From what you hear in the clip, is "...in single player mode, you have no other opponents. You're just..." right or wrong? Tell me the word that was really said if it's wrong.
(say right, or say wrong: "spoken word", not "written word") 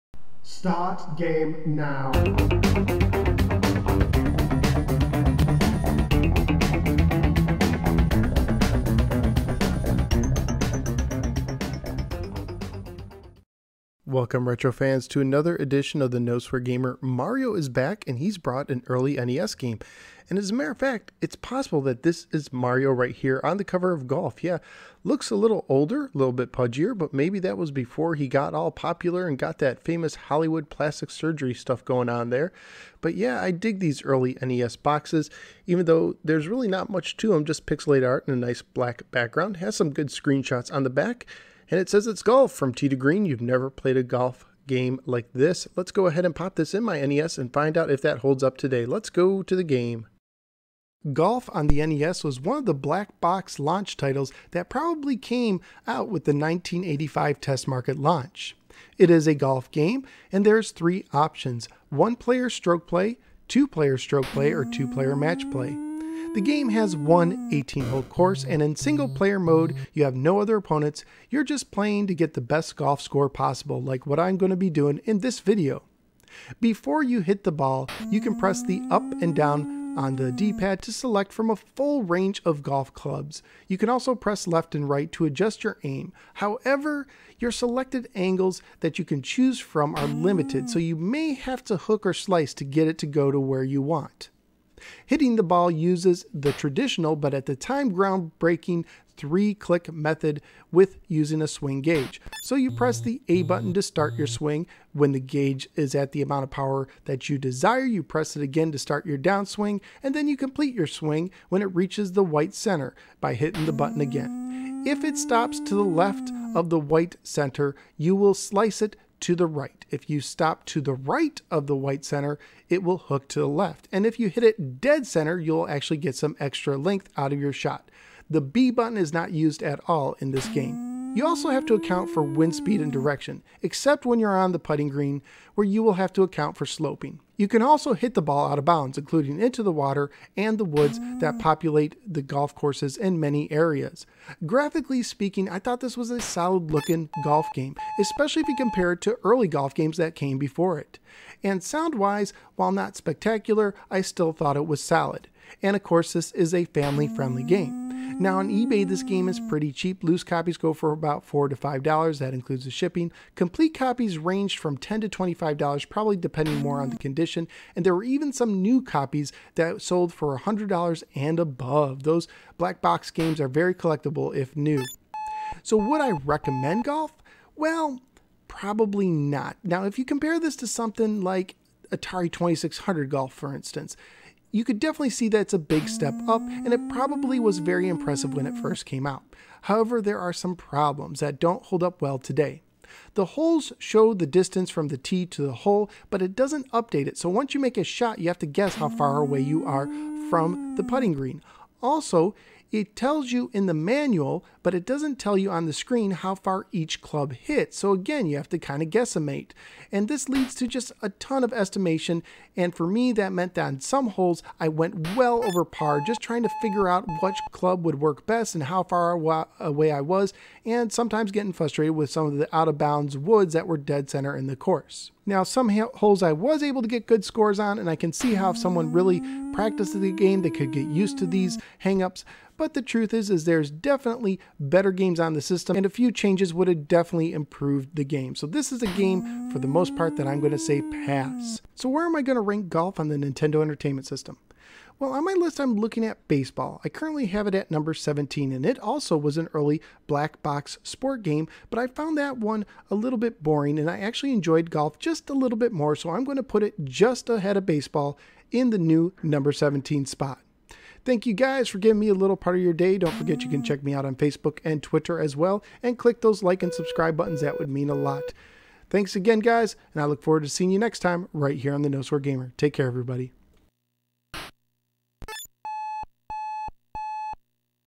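right.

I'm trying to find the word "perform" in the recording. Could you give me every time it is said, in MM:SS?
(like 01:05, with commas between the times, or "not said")
not said.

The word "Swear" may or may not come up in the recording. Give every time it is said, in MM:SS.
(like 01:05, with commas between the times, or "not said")
00:16, 04:32.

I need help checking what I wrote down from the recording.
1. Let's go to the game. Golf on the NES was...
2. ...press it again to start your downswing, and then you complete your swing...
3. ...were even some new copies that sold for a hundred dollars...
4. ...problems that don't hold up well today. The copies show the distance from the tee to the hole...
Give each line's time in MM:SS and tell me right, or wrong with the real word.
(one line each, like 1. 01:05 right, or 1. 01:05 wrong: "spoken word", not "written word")
1. 00:48 right
2. 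01:48 right
3. 02:47 right
4. 03:10 wrong: "holes", not "copies".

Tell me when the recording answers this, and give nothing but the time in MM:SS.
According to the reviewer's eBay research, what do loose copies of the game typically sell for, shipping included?
02:41.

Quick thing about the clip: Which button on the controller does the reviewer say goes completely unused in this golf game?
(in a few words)
B button.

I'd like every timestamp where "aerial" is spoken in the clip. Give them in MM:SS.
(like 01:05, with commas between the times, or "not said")
not said.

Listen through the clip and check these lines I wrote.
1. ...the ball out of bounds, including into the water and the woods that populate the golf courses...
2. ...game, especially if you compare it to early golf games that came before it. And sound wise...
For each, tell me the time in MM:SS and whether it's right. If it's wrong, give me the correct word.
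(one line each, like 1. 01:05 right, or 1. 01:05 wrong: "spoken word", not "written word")
1. 02:18 right
2. 02:27 right.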